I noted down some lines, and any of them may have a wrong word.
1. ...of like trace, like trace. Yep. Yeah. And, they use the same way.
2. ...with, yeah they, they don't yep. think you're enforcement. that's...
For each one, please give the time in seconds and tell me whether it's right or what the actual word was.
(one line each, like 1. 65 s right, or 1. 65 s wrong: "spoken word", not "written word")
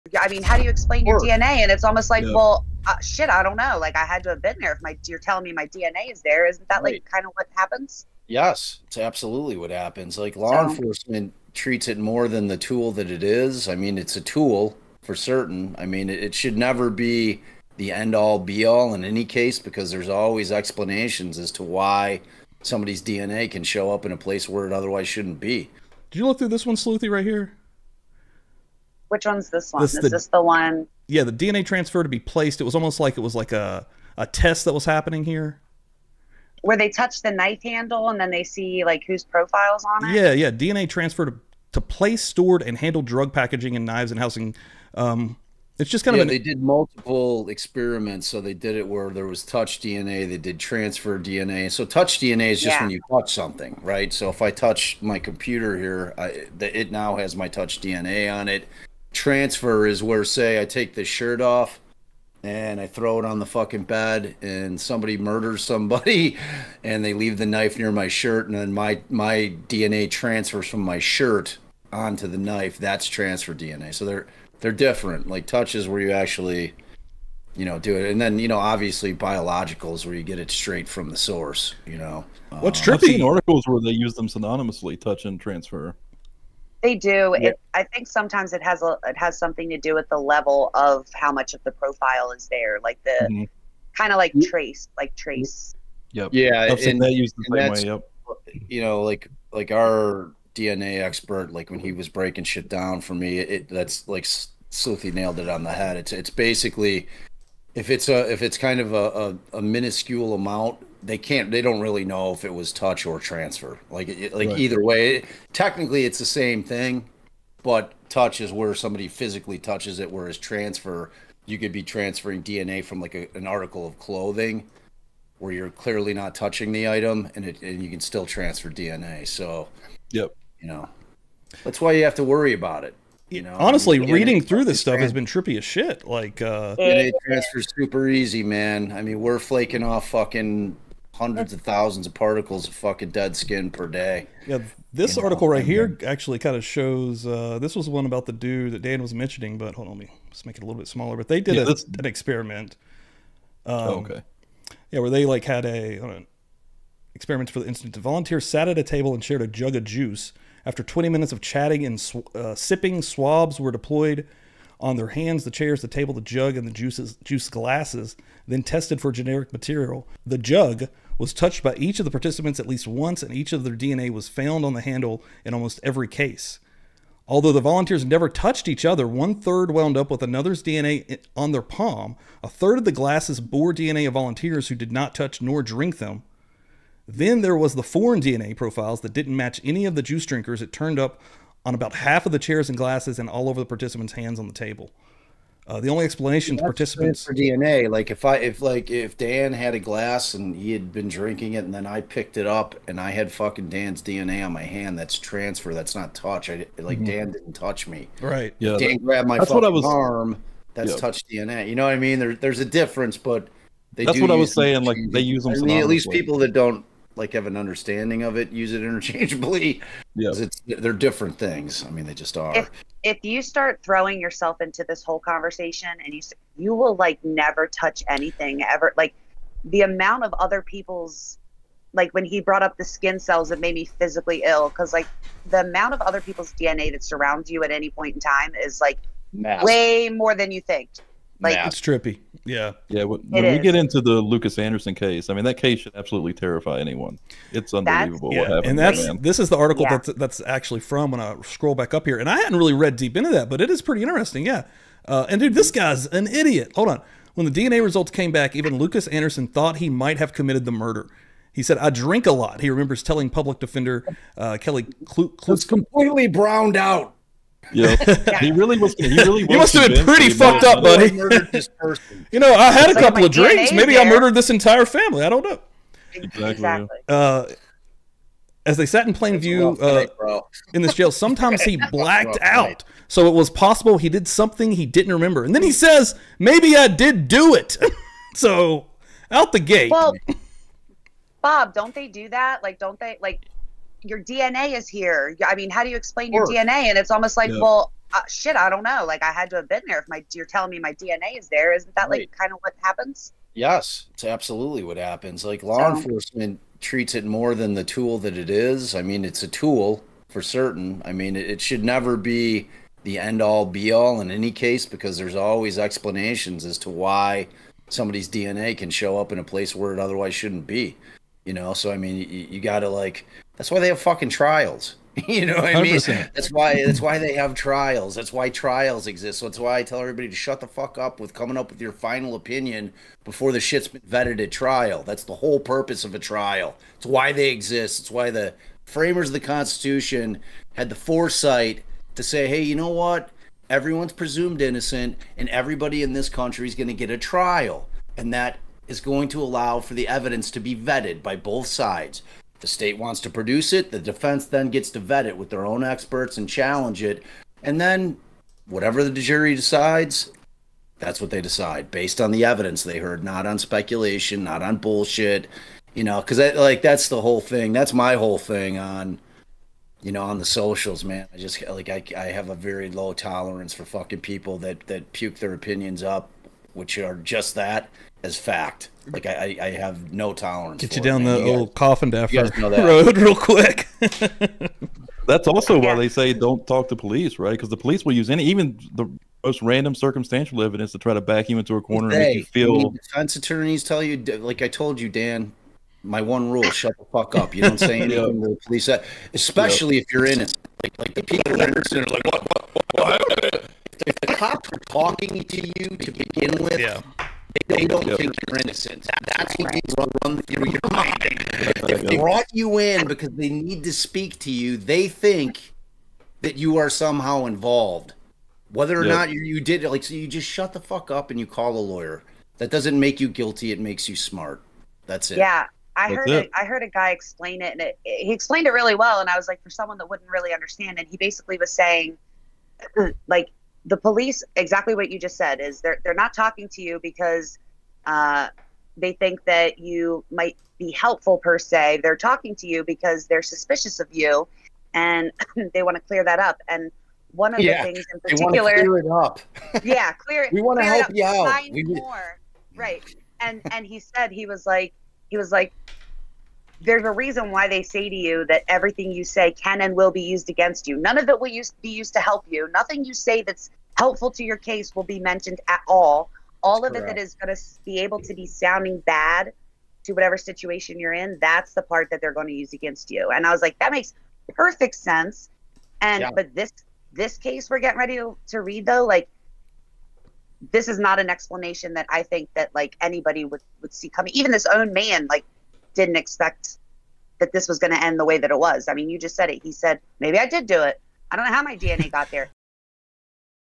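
1. 94 s right
2. 406 s wrong: "innocent", not "enforcement".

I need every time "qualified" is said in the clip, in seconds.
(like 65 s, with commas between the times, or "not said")
not said.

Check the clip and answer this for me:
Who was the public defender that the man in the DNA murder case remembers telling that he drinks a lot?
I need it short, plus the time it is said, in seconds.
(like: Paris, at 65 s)
Kelly Klutz, at 264 s.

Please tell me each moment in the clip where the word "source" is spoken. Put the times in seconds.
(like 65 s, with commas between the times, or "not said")
81 s.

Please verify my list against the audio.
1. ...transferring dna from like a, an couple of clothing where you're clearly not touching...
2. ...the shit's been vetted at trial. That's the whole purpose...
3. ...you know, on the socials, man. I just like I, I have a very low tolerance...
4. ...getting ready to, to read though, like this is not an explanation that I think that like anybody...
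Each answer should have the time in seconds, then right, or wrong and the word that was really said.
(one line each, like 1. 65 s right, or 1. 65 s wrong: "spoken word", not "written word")
1. 121 s wrong: "article", not "couple"
2. 333 s right
3. 370 s right
4. 477 s right.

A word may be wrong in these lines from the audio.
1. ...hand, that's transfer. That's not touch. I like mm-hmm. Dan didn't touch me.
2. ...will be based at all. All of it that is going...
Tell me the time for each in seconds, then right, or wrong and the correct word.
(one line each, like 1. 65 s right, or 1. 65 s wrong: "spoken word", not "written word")
1. 204 s right
2. 464 s wrong: "mentioned", not "based".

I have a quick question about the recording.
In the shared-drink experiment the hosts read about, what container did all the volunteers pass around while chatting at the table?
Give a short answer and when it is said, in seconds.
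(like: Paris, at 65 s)
jug of juice, at 159 s.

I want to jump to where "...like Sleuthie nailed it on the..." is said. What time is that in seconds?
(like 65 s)
104 s.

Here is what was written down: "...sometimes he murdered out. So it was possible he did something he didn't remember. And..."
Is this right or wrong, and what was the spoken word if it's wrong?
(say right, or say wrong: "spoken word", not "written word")
wrong: "blacked", not "murdered".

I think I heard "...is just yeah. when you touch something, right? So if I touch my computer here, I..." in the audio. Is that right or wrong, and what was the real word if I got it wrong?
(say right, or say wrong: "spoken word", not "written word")
right.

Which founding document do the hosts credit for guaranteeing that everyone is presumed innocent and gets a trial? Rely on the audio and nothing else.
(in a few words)
the Constitution.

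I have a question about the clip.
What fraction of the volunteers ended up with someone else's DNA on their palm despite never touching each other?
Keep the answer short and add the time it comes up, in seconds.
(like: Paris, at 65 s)
one third, at 179 s.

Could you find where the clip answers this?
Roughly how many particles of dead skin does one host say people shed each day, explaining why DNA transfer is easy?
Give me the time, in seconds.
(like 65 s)
141 s.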